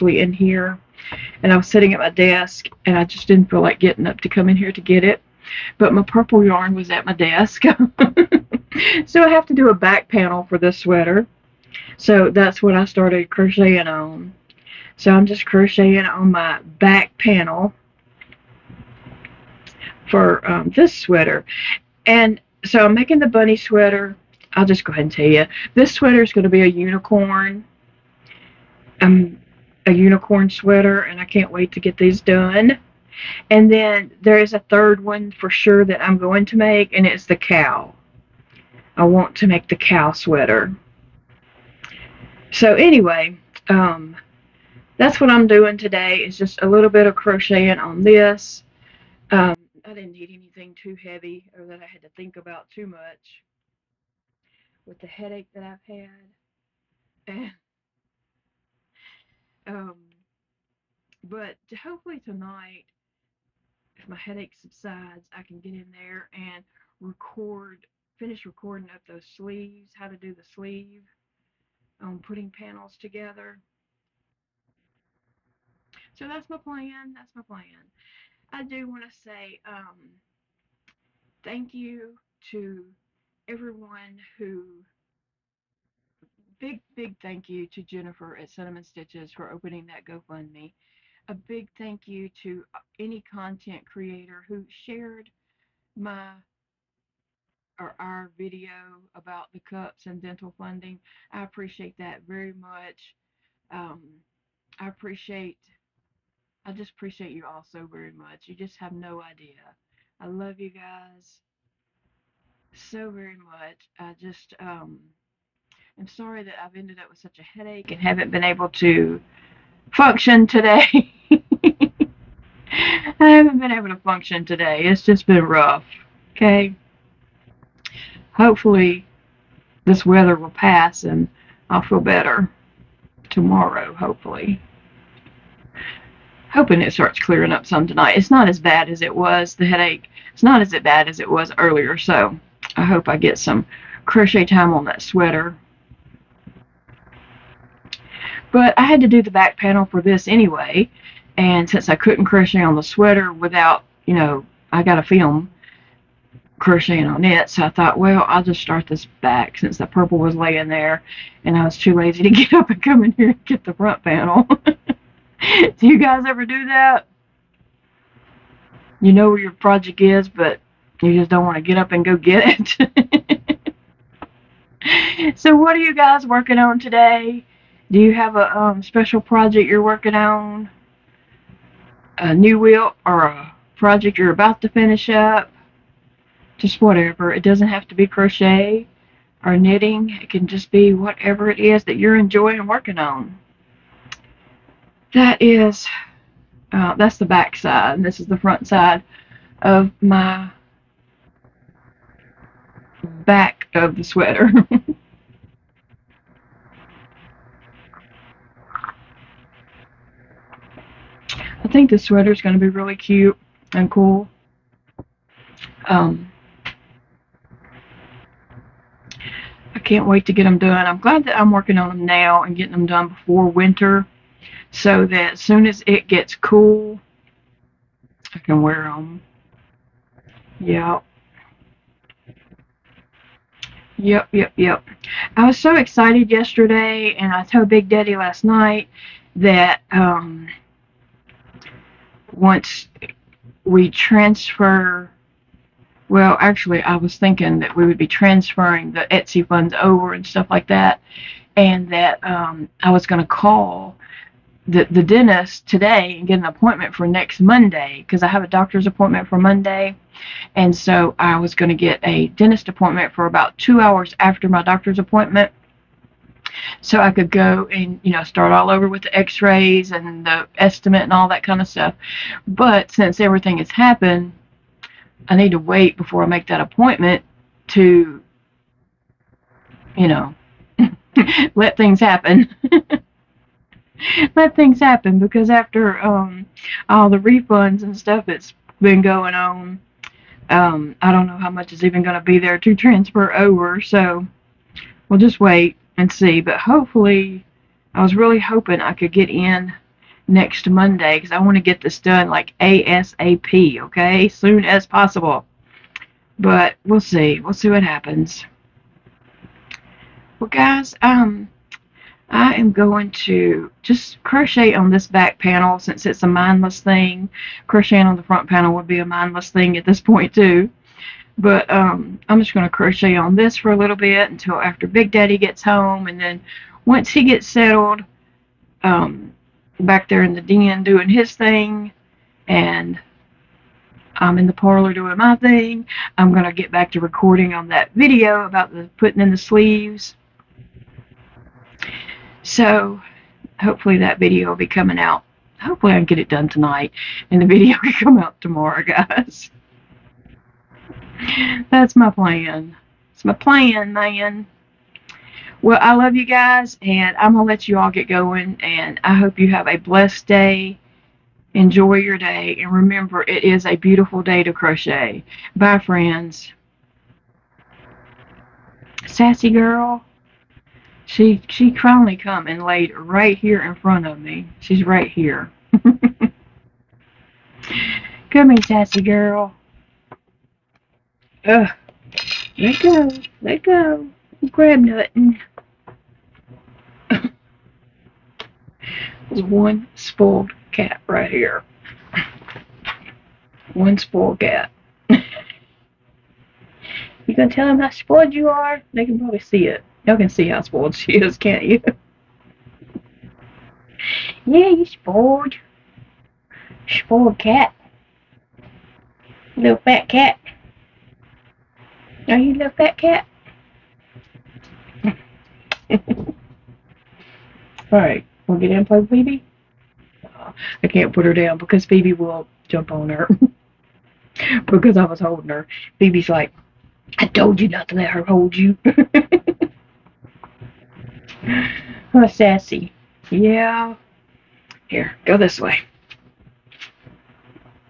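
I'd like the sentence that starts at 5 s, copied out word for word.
But my purple yarn was at my desk.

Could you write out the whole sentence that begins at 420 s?
I can't put her down because Phoebe will jump on her.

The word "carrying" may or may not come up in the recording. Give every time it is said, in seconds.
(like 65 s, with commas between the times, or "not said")
not said.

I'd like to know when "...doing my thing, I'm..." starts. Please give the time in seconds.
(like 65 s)
334 s.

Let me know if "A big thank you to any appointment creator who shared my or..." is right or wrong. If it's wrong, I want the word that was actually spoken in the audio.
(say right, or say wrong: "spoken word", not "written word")
wrong: "content", not "appointment".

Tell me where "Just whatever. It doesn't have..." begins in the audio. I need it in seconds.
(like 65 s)
186 s.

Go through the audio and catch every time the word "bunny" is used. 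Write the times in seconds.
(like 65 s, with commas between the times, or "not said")
23 s.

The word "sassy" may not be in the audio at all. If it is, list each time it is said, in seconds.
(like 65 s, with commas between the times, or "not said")
369 s, 378 s, 432 s.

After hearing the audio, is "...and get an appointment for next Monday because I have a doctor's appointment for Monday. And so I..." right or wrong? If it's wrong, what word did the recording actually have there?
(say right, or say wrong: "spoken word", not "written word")
right.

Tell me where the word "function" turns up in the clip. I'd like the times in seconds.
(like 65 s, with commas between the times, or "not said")
119 s, 123 s.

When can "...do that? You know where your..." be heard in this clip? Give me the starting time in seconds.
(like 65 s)
166 s.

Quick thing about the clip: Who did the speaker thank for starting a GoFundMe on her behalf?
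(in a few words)
Jennifer at Cinnamon Stitches.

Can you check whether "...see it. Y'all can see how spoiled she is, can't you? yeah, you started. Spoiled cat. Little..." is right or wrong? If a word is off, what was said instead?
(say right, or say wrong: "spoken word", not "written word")
wrong: "spoiled", not "started".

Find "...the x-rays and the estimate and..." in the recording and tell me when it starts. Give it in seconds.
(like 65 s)
269 s.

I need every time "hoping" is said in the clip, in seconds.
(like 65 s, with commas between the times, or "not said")
136 s, 298 s.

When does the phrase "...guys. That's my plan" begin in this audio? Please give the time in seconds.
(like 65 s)
348 s.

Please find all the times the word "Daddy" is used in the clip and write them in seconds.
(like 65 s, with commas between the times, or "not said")
237 s, 325 s.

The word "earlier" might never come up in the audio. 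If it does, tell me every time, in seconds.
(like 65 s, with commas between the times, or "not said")
141 s.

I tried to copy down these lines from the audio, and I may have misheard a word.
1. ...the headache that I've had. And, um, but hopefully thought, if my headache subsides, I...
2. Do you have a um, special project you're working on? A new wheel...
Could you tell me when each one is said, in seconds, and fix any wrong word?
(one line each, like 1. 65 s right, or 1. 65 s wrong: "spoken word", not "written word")
1. 54 s wrong: "tonight", not "thought"
2. 177 s right.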